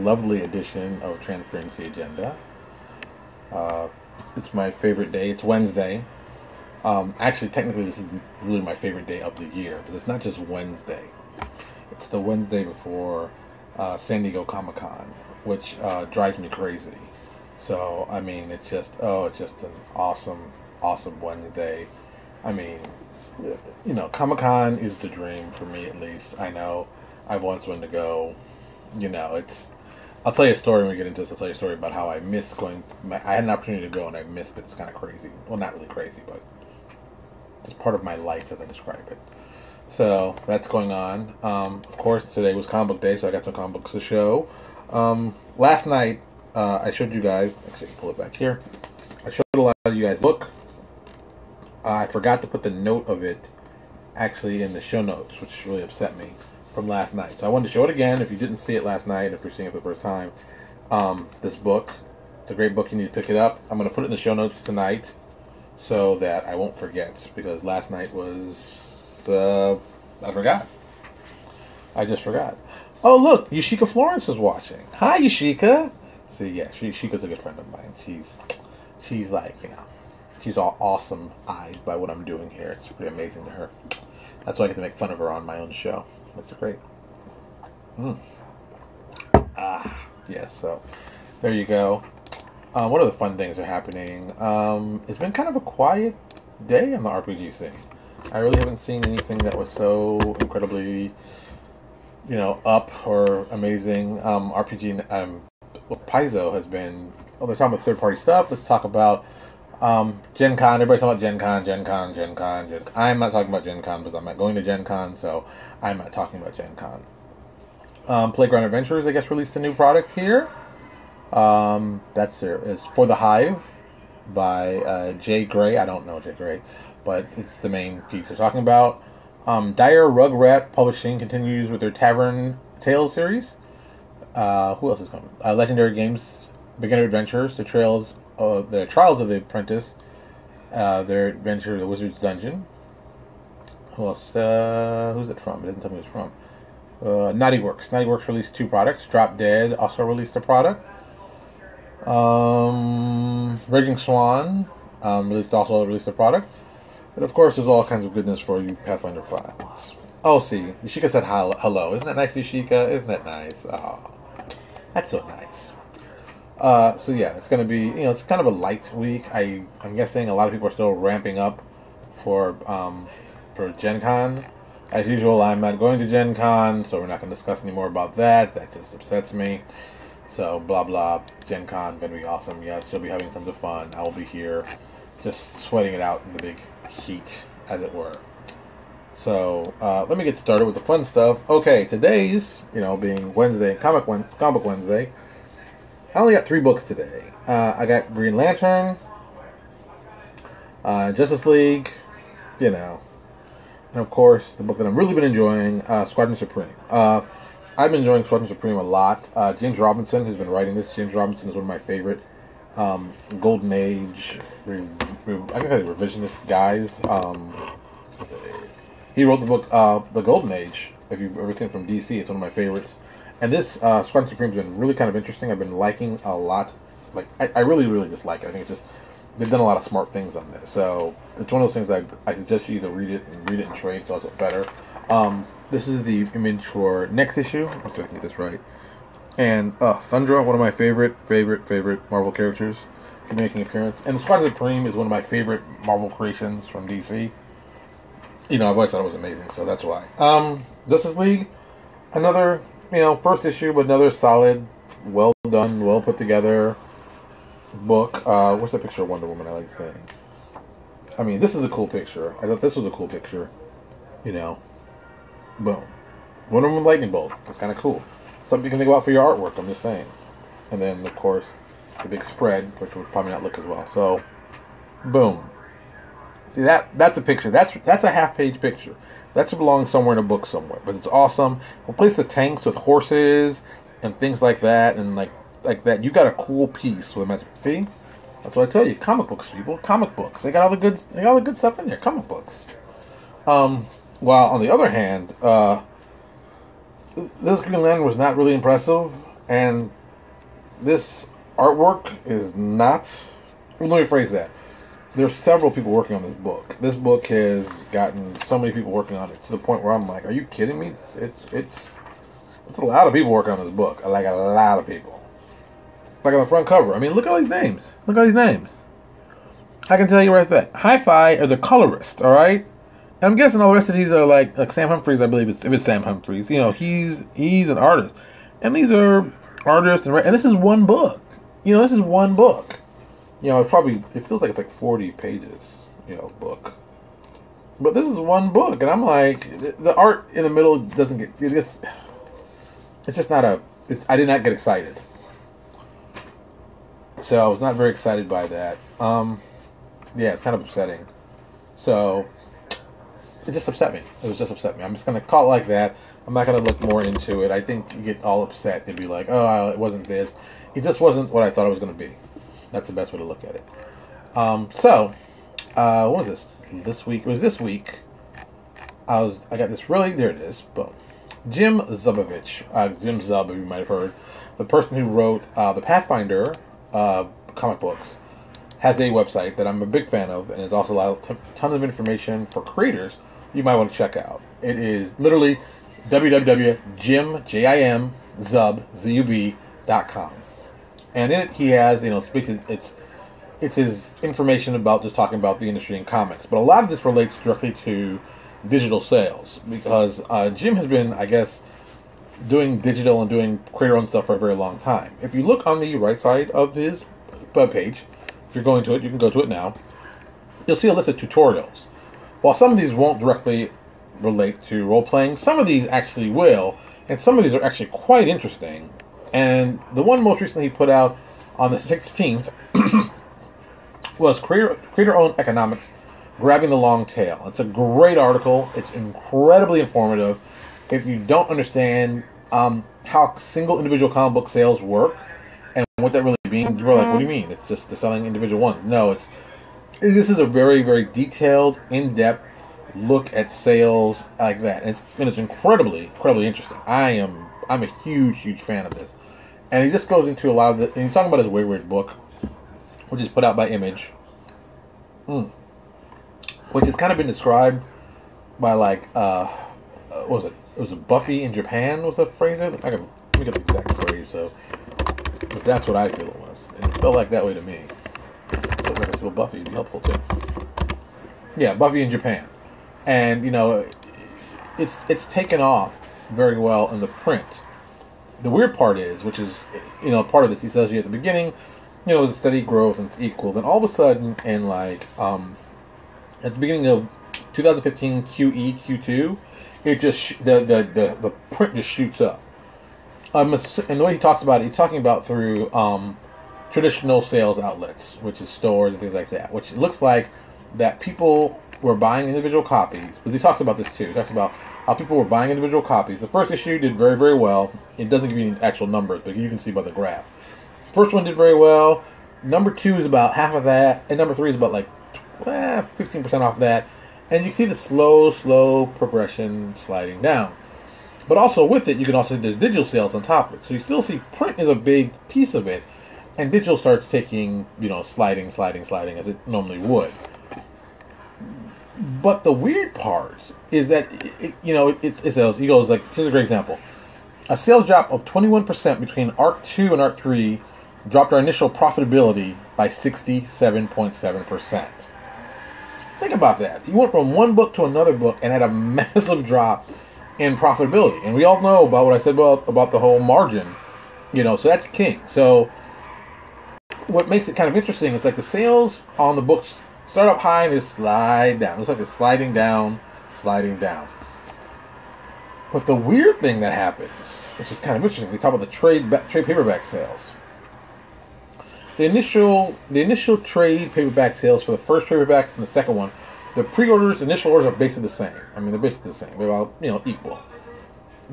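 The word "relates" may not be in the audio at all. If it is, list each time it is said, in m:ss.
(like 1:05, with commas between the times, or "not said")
6:37, 6:54.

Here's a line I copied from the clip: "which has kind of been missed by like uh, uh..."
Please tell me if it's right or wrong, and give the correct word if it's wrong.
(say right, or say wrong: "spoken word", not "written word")
wrong: "described", not "missed".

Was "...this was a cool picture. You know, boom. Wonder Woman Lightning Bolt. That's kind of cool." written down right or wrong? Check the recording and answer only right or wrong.
right.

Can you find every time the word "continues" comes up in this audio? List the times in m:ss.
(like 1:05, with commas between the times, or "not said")
2:11.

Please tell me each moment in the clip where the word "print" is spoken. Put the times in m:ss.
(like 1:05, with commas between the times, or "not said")
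7:57, 8:11, 8:44.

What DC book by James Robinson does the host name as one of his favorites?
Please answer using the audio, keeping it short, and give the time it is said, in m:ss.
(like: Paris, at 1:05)
The Golden Age, at 3:40.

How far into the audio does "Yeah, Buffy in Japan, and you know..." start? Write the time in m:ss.
7:51.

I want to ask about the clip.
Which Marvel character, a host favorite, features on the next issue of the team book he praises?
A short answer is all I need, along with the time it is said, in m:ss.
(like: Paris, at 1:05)
Thundra, at 3:59.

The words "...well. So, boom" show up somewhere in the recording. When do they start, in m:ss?
4:33.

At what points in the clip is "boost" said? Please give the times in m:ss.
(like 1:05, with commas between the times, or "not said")
not said.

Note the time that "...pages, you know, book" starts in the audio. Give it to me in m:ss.
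5:35.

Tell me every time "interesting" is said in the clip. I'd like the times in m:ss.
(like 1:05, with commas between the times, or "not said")
3:45, 6:58, 7:26, 9:17, 9:28.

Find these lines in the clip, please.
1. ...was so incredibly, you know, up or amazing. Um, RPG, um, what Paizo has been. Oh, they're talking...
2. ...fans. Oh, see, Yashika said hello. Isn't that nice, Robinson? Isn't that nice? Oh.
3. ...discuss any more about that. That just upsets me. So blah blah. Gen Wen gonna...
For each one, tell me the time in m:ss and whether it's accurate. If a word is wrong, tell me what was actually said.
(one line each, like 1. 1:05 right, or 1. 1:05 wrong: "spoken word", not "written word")
1. 1:39 right
2. 2:39 wrong: "Yashika", not "Robinson"
3. 2:57 wrong: "Con", not "Wen".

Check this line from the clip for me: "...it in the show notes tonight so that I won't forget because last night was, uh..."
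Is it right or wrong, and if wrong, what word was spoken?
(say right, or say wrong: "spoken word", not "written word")
right.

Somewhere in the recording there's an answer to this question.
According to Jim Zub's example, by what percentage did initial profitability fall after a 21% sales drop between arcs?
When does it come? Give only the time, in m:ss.
9:02.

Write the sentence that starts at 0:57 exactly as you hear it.
So I wanted to show it again if you didn't see it last night, if you're seeing it for the first time.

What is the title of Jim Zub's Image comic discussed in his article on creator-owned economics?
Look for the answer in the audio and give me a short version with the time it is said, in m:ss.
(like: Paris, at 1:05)
Wayward, at 7:31.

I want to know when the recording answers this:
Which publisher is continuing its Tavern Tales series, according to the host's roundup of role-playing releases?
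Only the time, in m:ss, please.
2:09.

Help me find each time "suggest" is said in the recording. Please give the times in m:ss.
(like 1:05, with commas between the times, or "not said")
3:52.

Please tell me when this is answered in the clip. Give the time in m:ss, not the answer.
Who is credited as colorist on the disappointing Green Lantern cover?
5:20.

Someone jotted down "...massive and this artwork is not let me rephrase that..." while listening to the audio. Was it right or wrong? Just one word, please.
wrong.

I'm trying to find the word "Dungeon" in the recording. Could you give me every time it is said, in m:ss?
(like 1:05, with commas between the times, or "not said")
2:22.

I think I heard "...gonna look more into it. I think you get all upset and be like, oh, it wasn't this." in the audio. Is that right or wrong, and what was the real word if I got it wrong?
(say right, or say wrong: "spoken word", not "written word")
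right.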